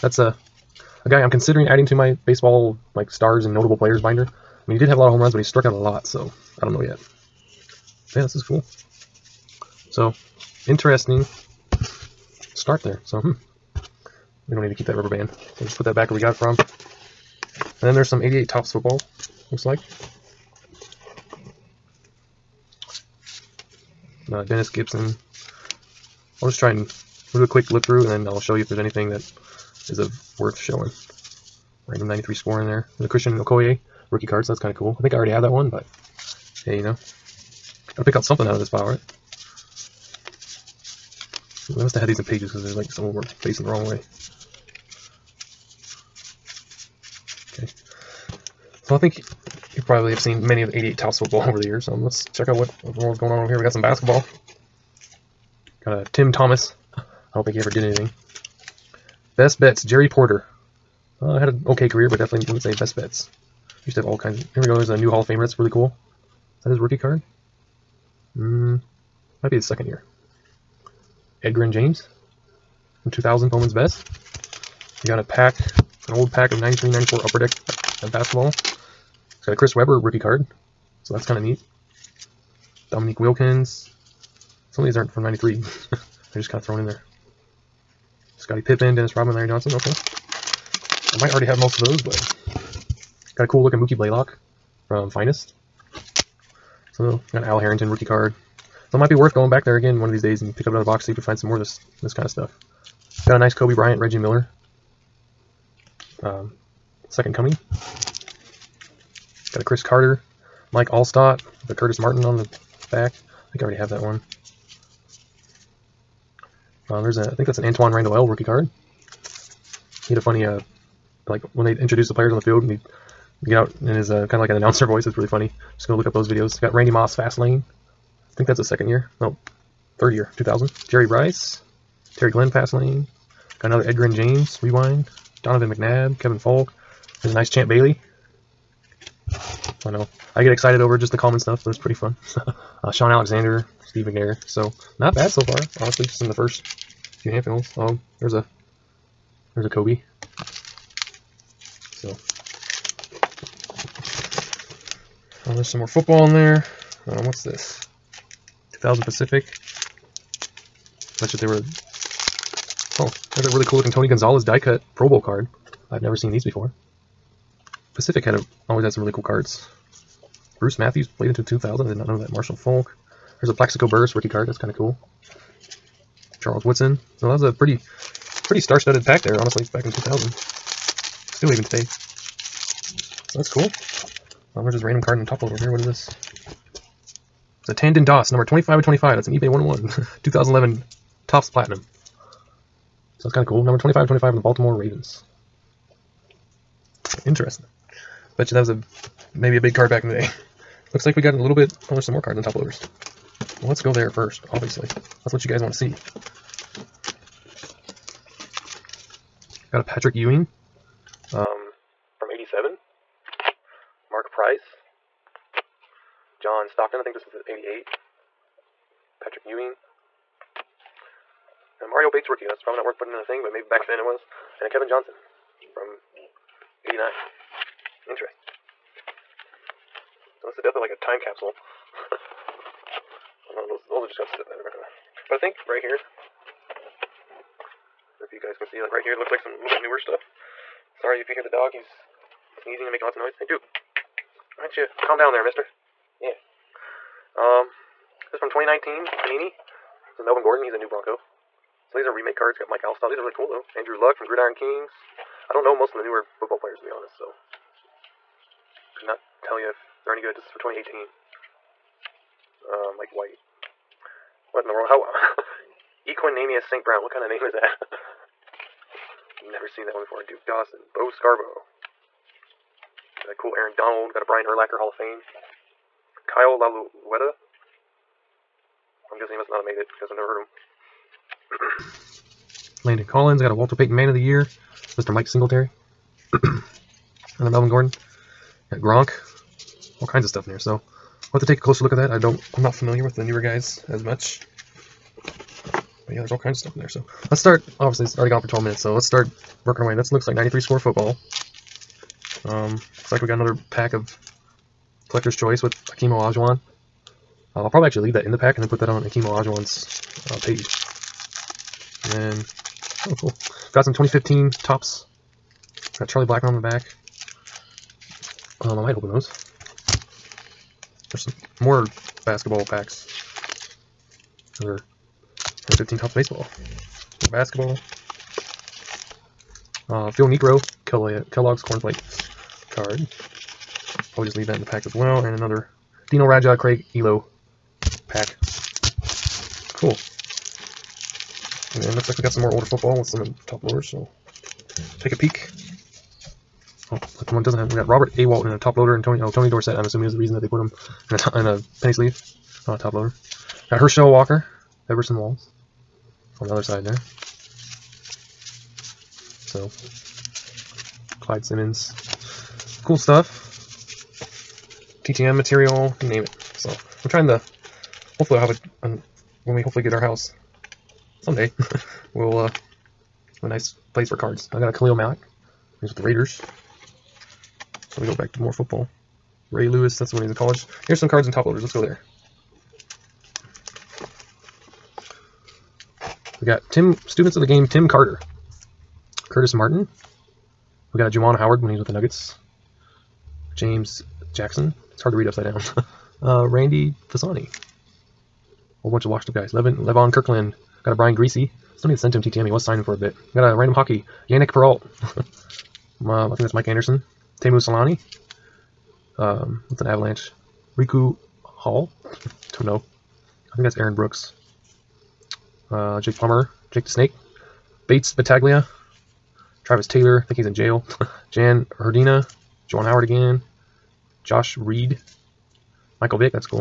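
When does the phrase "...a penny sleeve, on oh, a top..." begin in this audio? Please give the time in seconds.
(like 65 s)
351 s.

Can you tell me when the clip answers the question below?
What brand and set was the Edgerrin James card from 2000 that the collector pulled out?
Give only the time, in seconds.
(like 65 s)
73 s.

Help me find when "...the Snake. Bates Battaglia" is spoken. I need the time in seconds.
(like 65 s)
416 s.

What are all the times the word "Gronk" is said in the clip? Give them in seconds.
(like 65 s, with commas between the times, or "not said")
288 s.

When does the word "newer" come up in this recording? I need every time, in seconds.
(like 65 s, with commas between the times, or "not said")
239 s, 256 s, 293 s.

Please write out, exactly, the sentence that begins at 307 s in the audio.
Uh, I'll probably actually leave that in the pack and then put that on Akeem Olajuwon's uh, page.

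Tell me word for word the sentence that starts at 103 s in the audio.
Got a nice Kobe Bryant, Reggie Miller.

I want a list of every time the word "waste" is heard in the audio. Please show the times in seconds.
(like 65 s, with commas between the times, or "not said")
not said.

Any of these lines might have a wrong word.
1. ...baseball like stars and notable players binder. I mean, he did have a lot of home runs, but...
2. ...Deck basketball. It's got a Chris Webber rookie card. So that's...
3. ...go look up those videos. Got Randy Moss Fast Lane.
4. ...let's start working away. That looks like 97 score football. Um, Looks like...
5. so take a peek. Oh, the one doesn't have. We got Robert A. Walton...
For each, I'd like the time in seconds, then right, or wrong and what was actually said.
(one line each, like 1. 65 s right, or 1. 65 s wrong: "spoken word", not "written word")
1. 2 s right
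2. 77 s right
3. 125 s right
4. 298 s wrong: "93", not "97"
5. 343 s right.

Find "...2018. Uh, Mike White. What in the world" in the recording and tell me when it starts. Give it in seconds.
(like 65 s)
260 s.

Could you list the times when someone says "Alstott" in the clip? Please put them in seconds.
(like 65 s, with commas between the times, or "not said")
110 s, 252 s.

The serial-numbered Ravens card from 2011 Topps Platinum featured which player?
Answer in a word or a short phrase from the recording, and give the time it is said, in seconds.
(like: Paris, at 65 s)
Tandon Doss, at 187 s.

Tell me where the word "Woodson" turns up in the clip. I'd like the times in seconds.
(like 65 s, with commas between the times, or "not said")
176 s.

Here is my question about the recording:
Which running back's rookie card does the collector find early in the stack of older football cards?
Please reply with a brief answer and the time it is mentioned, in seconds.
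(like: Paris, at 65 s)
Christian Okoye, at 33 s.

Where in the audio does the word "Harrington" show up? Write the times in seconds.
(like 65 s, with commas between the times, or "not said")
97 s.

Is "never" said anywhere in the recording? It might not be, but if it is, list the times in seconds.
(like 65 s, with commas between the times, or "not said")
166 s, 269 s, 280 s.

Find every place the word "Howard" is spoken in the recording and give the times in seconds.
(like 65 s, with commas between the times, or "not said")
391 s, 422 s.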